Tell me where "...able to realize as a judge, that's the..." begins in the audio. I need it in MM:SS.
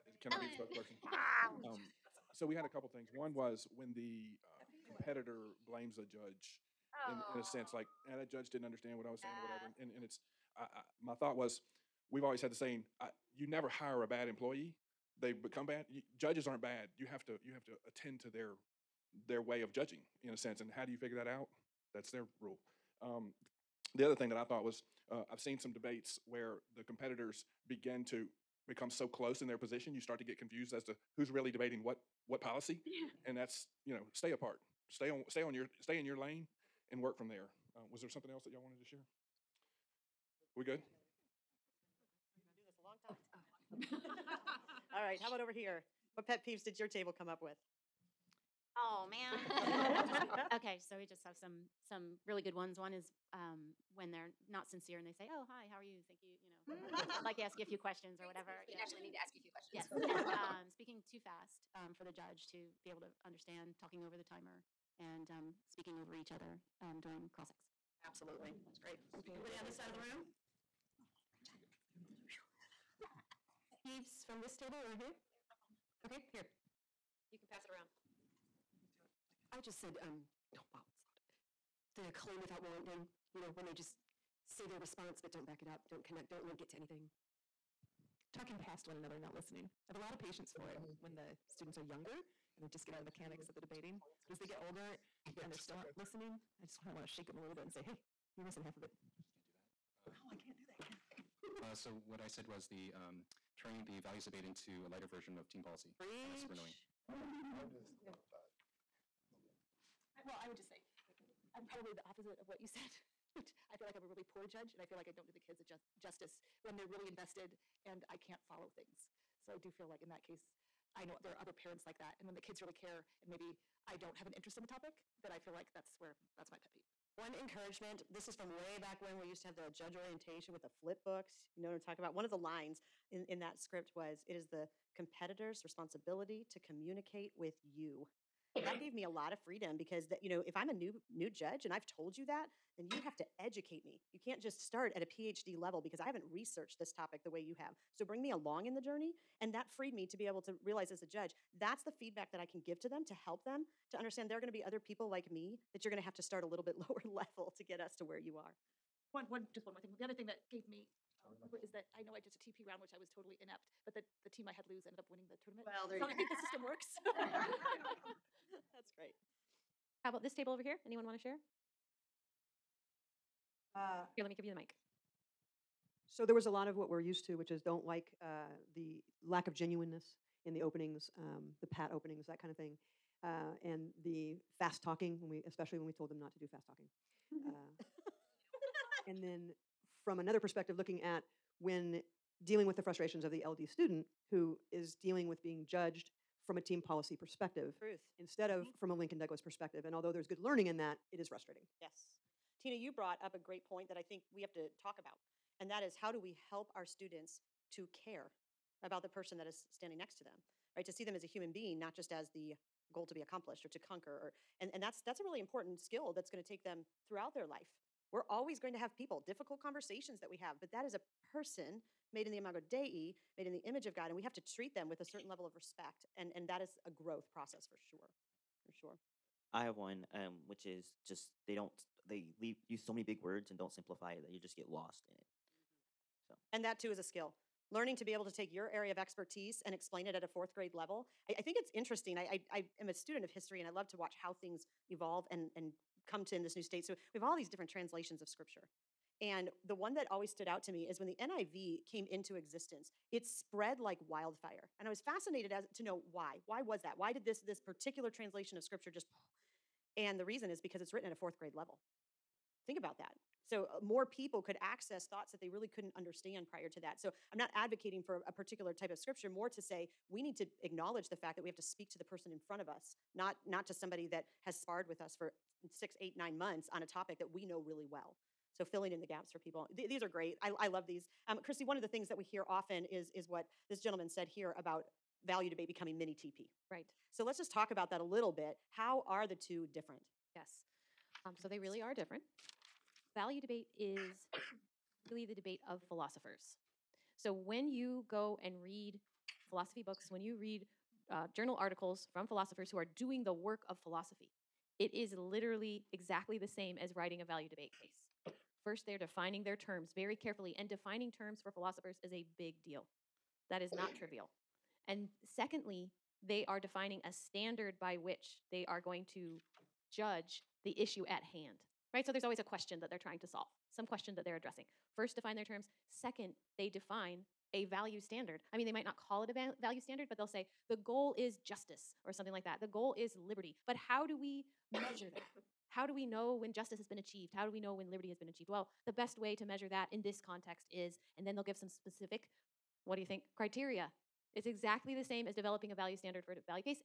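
02:30.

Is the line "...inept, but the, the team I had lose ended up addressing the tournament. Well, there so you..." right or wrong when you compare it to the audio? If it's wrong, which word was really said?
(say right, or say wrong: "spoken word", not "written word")
wrong: "winning", not "addressing".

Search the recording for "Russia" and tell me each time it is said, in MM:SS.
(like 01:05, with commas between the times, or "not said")
not said.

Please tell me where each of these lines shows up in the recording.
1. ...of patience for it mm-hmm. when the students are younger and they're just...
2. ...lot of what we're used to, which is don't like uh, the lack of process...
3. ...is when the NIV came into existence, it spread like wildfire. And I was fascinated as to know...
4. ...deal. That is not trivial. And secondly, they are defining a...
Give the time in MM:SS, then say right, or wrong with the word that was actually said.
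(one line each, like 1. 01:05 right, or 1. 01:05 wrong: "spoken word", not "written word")
1. 01:30 right
2. 02:56 wrong: "genuineness", not "process"
3. 04:10 right
4. 05:12 right.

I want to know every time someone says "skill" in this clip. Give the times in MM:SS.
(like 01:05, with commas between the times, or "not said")
03:35, 03:57.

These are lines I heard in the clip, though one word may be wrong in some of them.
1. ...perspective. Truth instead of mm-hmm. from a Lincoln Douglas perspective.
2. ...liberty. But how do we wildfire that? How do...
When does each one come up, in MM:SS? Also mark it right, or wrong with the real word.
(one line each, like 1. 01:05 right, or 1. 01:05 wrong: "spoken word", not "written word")
1. 03:17 right
2. 05:33 wrong: "measure", not "wildfire".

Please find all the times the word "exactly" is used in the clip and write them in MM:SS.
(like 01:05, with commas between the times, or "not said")
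05:05, 05:44.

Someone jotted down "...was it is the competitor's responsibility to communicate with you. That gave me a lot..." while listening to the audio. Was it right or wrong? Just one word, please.
right.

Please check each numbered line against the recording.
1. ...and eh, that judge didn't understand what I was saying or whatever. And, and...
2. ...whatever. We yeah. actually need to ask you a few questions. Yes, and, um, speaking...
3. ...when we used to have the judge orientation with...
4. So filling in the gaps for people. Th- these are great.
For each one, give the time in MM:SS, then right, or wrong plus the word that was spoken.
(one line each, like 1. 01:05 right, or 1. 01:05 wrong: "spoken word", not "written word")
1. 00:08 right
2. 00:58 right
3. 02:09 right
4. 04:38 right.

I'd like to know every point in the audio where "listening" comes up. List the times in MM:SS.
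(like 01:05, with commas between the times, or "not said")
01:29, 01:35.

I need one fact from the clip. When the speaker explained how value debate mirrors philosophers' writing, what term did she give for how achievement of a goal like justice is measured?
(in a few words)
Criteria.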